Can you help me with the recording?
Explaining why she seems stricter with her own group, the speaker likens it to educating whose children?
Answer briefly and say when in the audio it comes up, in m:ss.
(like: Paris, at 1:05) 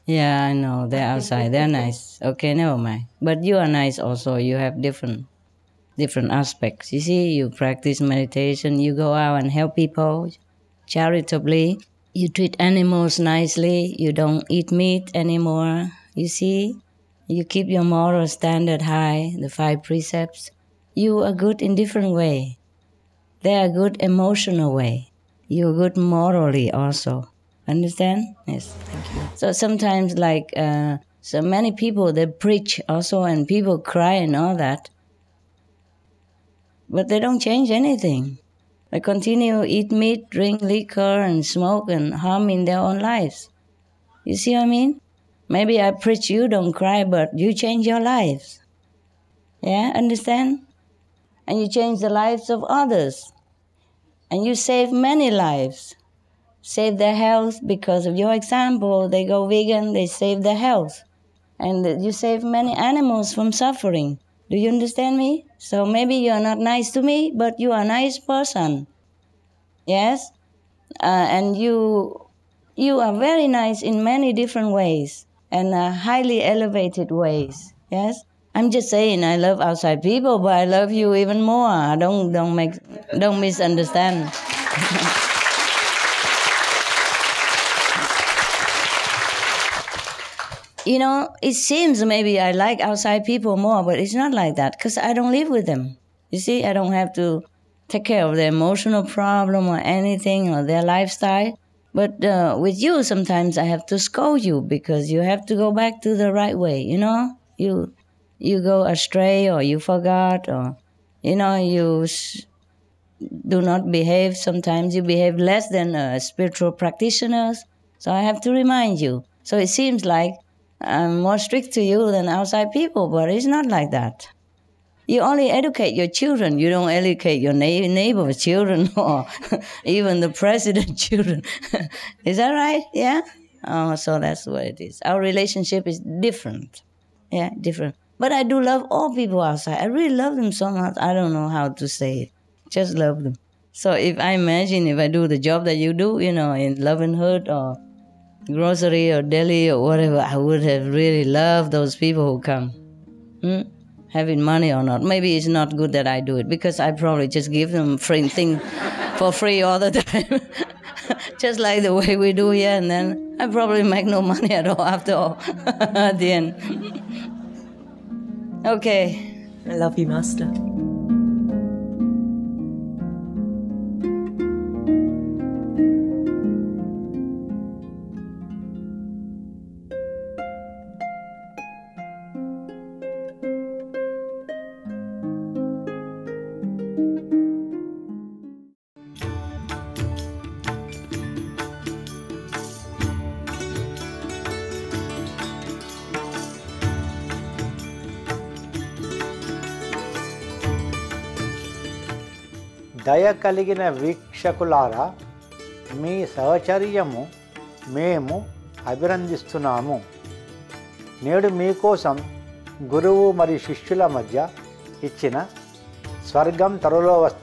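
Your children, at 2:05.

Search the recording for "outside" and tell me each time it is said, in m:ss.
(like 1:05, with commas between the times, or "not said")
0:01, 1:19, 1:32, 2:02, 2:19.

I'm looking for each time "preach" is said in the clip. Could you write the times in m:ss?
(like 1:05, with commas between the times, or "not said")
0:32, 0:45.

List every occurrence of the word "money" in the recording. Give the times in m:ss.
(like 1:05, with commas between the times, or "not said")
2:34, 2:44.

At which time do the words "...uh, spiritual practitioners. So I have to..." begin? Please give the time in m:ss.
1:55.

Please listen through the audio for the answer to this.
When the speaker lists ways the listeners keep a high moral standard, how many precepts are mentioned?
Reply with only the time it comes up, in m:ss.
0:19.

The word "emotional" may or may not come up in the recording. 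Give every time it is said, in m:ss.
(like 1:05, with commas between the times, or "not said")
0:23, 1:38.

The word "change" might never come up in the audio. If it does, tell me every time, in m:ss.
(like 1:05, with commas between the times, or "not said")
0:37, 0:47, 0:51.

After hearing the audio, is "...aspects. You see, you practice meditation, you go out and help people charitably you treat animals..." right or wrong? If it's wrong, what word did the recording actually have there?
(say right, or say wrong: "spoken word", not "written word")
right.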